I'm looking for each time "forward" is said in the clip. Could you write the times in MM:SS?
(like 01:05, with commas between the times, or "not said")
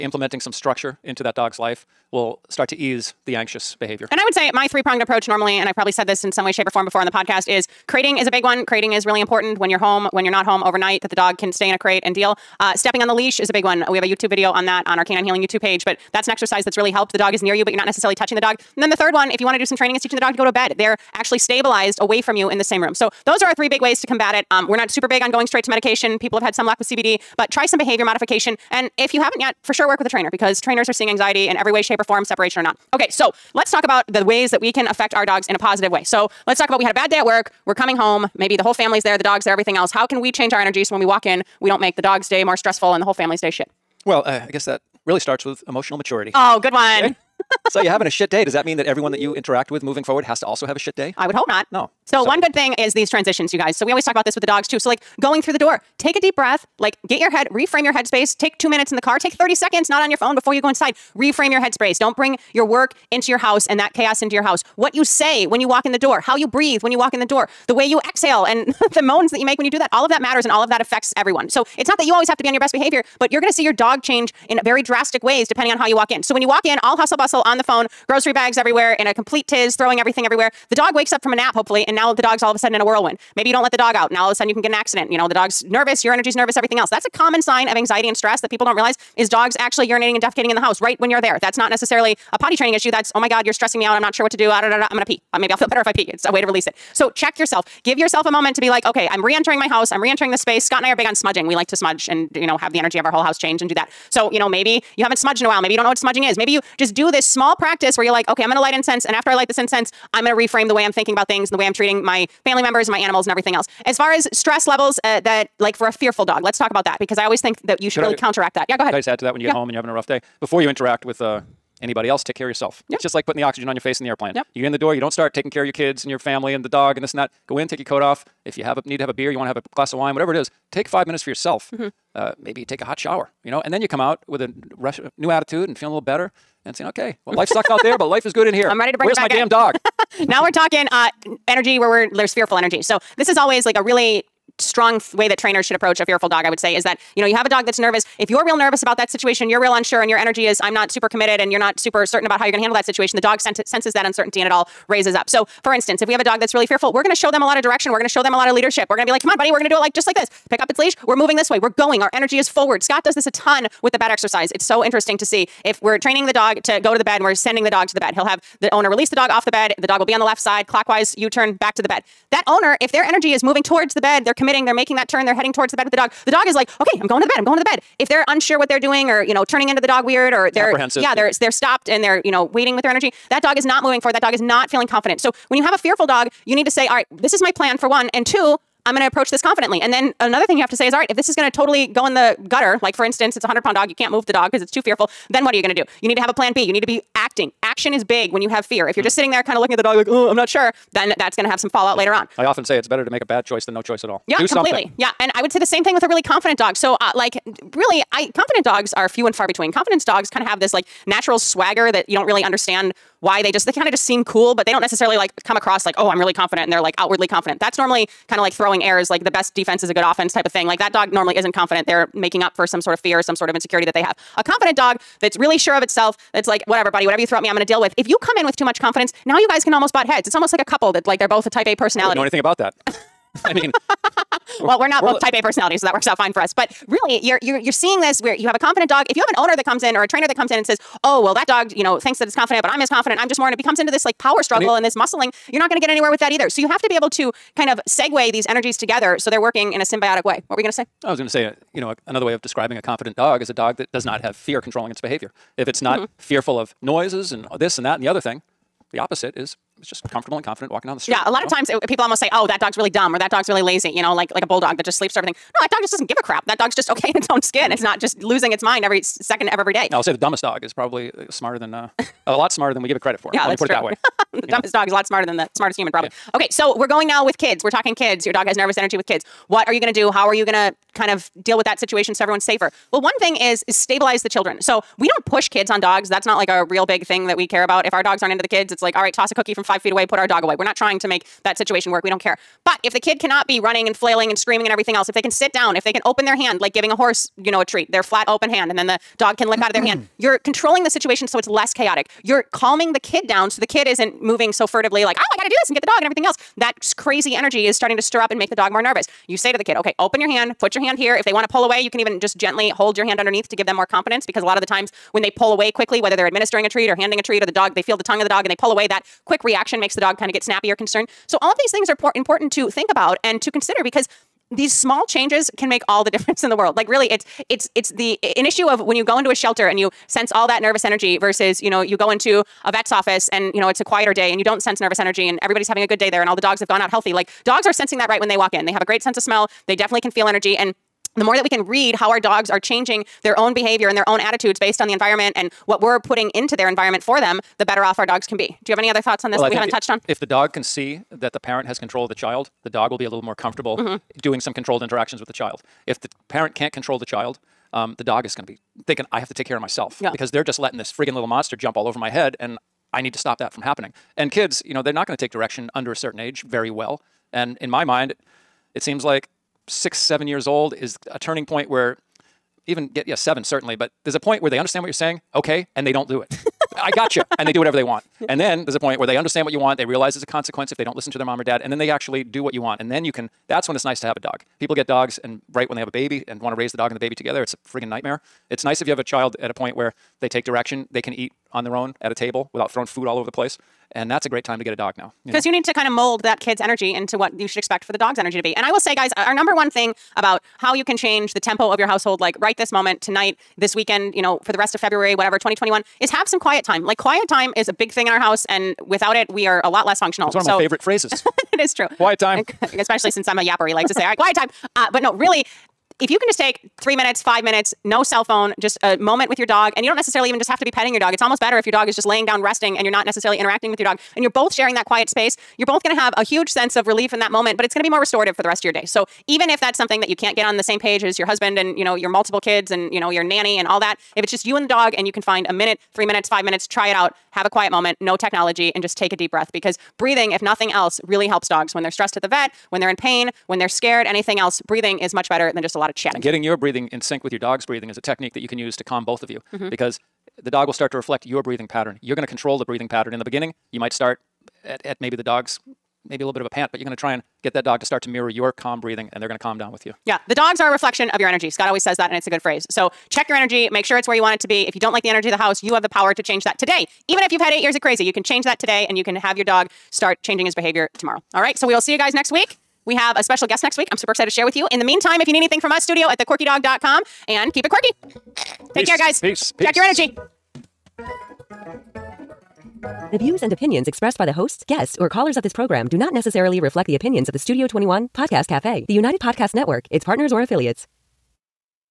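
00:50, 02:42, 03:03.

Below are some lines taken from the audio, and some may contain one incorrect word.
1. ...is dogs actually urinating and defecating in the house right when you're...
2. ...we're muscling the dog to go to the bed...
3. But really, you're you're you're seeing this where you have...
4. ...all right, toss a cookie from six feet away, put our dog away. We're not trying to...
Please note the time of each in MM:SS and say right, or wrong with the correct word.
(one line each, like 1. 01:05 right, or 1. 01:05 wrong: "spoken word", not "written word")
1. 01:29 right
2. 02:45 wrong: "training", not "muscling"
3. 03:56 right
4. 04:48 wrong: "five", not "six".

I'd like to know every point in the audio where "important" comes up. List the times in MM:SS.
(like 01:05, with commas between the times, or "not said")
00:09, 05:22.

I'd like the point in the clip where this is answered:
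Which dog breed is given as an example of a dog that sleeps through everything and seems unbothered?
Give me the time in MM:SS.
04:24.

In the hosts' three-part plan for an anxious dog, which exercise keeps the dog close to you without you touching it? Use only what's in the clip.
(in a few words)
Stepping on the leash.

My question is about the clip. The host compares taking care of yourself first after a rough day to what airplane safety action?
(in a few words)
Putting the oxygen on.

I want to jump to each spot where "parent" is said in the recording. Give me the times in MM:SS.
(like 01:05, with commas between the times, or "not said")
05:51, 05:56.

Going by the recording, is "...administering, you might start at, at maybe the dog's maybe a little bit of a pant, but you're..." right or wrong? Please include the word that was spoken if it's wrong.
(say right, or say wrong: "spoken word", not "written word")
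wrong: "beginning", not "administering".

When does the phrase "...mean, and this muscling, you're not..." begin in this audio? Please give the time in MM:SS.
04:04.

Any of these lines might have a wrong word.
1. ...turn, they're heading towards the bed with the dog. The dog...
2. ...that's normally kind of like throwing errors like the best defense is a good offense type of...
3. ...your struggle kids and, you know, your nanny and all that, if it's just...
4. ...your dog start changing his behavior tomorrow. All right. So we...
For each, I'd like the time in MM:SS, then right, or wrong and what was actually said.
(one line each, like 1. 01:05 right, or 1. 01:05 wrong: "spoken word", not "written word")
1. 02:55 right
2. 03:37 right
3. 07:11 wrong: "multiple", not "struggle"
4. 07:49 right.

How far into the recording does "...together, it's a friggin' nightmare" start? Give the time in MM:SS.
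06:27.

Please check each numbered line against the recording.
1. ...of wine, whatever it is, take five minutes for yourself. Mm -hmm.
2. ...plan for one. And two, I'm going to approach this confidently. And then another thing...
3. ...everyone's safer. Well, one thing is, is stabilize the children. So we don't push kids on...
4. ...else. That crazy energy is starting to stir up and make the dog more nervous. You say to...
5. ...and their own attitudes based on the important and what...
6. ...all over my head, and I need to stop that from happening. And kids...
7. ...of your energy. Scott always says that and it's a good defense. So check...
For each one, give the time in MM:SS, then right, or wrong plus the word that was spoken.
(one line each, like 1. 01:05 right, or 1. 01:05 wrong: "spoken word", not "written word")
1. 02:09 right
2. 03:07 right
3. 04:42 right
4. 05:06 right
5. 05:43 wrong: "environment", not "important"
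6. 06:01 right
7. 07:41 wrong: "phrase", not "defense".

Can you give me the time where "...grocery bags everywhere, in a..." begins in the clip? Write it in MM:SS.
01:18.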